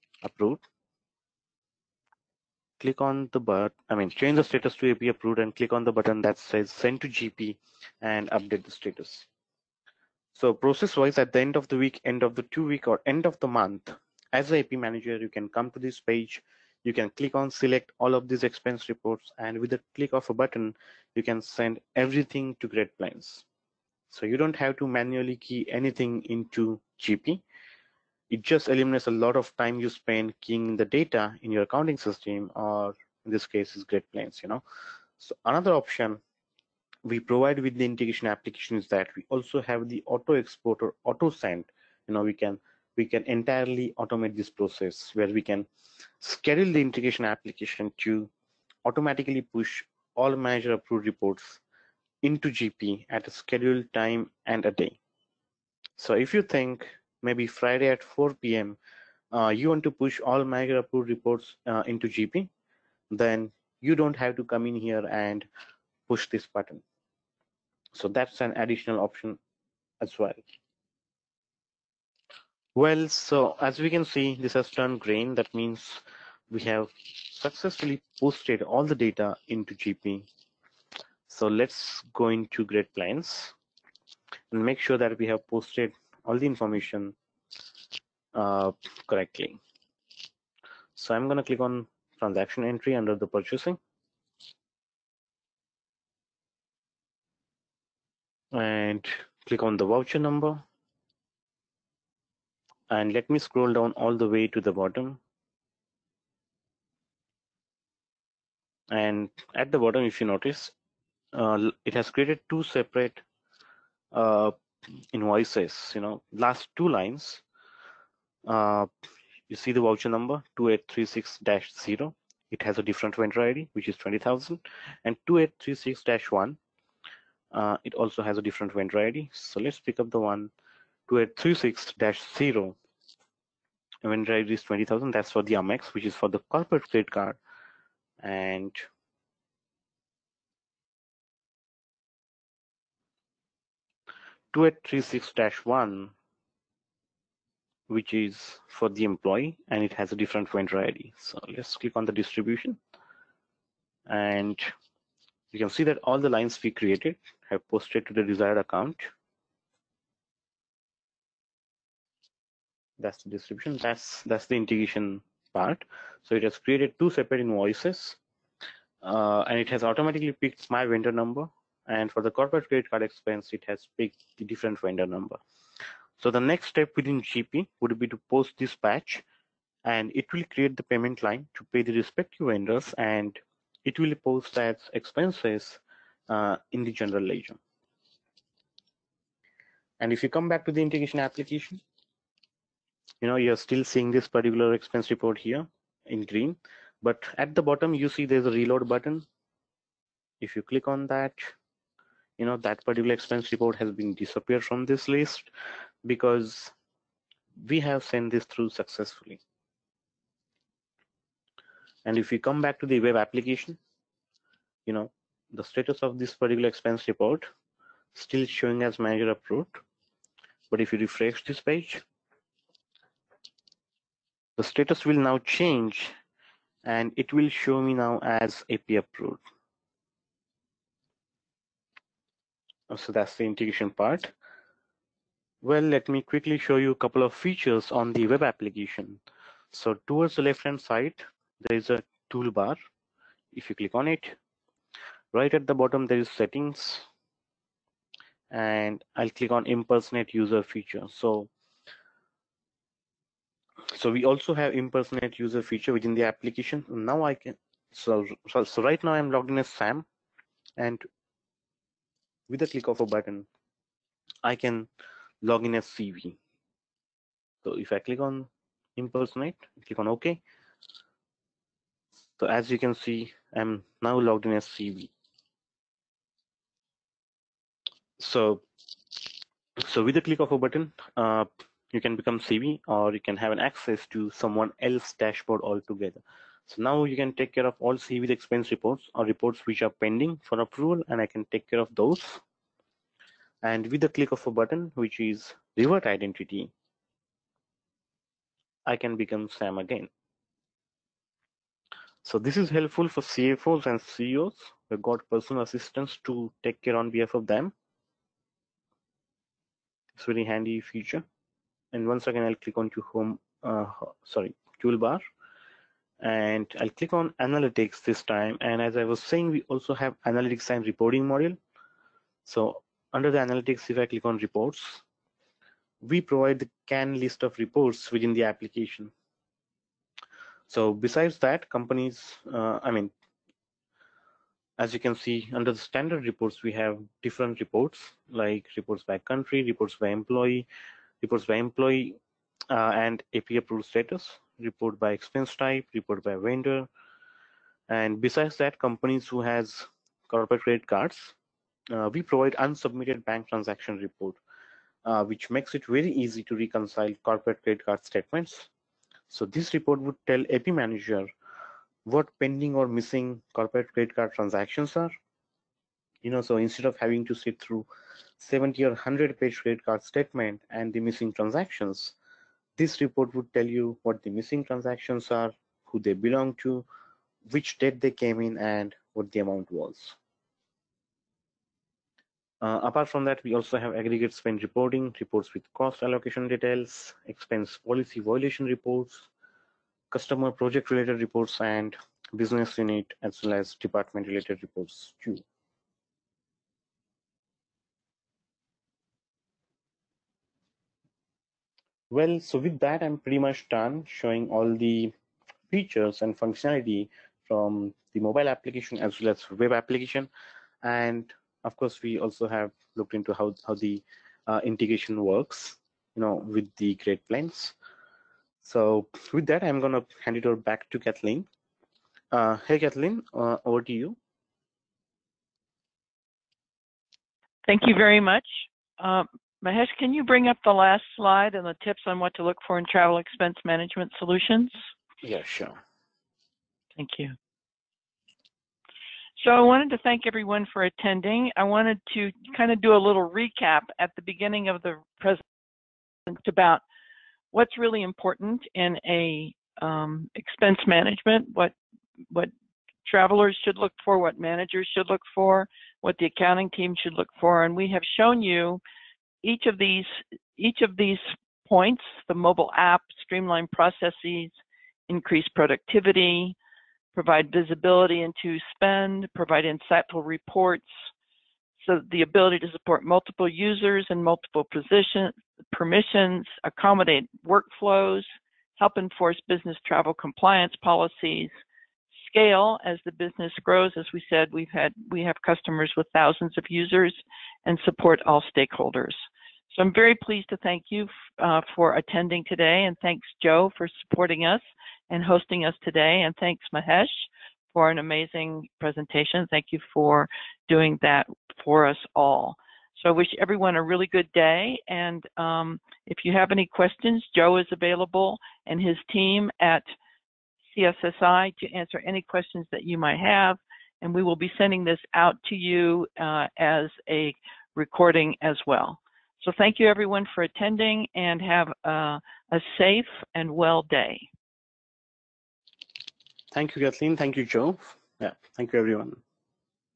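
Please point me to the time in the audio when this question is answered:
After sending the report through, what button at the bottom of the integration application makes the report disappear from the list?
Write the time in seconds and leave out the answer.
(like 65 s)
198 s.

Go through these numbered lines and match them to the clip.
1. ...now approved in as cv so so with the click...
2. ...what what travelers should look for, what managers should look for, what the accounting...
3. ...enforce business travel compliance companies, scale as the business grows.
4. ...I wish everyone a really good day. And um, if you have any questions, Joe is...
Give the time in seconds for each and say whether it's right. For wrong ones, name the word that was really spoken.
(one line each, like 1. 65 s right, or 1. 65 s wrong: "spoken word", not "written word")
1. 274 s wrong: "logged", not "approved"
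2. 451 s right
3. 478 s wrong: "policies", not "companies"
4. 503 s right.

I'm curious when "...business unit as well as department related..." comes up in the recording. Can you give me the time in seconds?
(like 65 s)
392 s.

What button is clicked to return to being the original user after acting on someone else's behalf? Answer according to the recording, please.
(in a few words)
revert identity.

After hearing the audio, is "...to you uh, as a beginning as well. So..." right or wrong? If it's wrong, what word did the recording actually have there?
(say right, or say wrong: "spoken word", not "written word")
wrong: "recording", not "beginning".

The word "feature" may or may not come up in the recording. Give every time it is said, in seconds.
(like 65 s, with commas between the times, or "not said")
237 s, 250 s, 255 s, 310 s, 405 s.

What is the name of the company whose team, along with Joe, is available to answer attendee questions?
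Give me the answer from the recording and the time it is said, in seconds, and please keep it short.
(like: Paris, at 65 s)
CSSI, at 510 s.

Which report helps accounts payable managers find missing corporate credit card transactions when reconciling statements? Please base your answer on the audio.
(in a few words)
unsubmitted bank transaction report.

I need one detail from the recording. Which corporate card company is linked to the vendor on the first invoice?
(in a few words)
Amex.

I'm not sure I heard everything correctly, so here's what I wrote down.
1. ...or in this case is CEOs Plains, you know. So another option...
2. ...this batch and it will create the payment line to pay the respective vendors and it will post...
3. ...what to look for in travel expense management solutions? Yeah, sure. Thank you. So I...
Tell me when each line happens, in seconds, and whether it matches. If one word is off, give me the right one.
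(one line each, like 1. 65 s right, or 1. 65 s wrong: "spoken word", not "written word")
1. 32 s wrong: "Great", not "CEOs"
2. 178 s right
3. 432 s right.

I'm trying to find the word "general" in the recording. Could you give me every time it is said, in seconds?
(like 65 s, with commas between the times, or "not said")
186 s.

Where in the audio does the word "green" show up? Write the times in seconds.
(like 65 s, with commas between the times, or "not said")
75 s, 196 s.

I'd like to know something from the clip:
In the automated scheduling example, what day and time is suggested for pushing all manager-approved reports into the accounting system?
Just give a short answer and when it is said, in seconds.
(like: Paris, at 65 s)
Friday at 4 p.m., at 57 s.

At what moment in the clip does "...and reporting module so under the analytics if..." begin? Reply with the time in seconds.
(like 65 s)
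320 s.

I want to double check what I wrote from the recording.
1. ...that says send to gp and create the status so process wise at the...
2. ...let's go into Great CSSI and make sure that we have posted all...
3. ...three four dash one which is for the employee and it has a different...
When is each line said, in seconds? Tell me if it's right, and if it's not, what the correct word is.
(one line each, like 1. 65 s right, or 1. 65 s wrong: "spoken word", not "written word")
1. 6 s wrong: "update", not "create"
2. 81 s wrong: "Plains", not "CSSI"
3. 144 s wrong: "six", not "four".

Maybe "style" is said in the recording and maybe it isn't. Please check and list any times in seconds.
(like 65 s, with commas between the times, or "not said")
not said.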